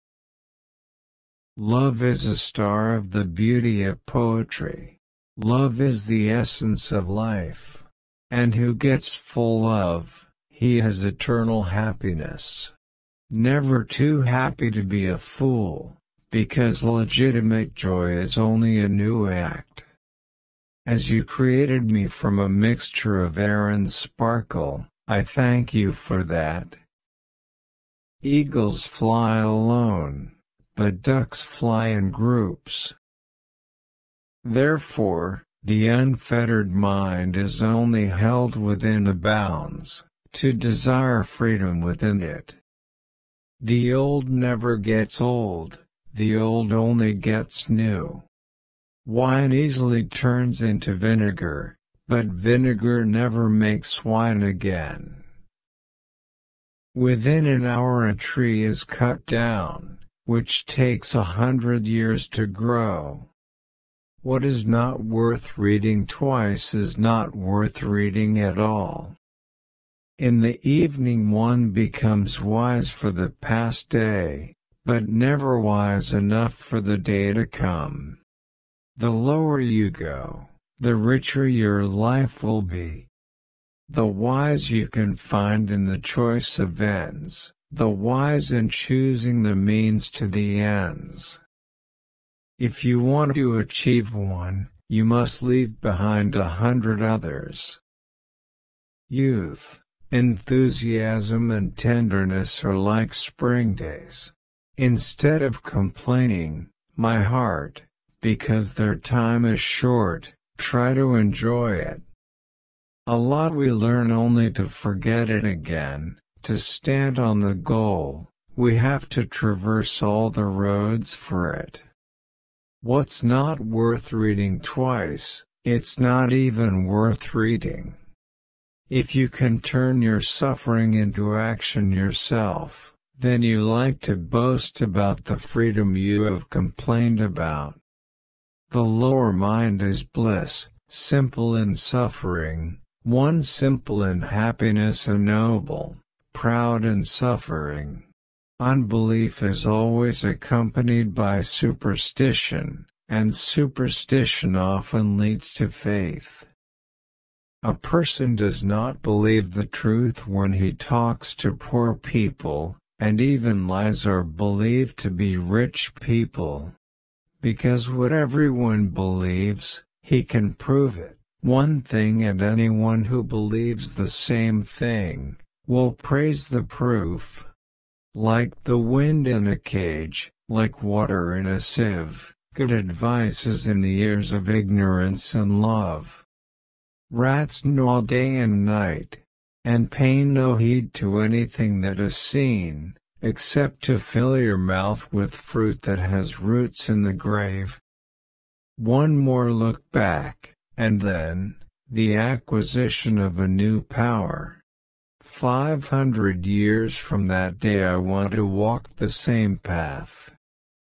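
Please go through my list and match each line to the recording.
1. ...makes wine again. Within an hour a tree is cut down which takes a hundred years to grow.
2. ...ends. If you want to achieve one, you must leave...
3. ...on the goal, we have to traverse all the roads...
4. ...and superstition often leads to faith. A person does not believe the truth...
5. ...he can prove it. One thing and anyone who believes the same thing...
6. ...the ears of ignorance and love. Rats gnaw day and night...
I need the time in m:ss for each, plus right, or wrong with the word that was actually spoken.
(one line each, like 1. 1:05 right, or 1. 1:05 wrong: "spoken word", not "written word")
1. 0:53 right
2. 1:30 right
3. 1:57 right
4. 2:33 right
5. 2:50 right
6. 3:03 right.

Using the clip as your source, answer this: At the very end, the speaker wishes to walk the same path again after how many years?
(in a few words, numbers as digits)
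500.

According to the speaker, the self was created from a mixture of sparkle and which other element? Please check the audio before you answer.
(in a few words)
air.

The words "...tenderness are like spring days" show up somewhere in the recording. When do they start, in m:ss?
1:41.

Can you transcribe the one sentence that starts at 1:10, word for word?
In the evening one becomes wise for the past day, but never wise enough for the day to come.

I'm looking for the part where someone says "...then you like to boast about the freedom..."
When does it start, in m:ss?
2:13.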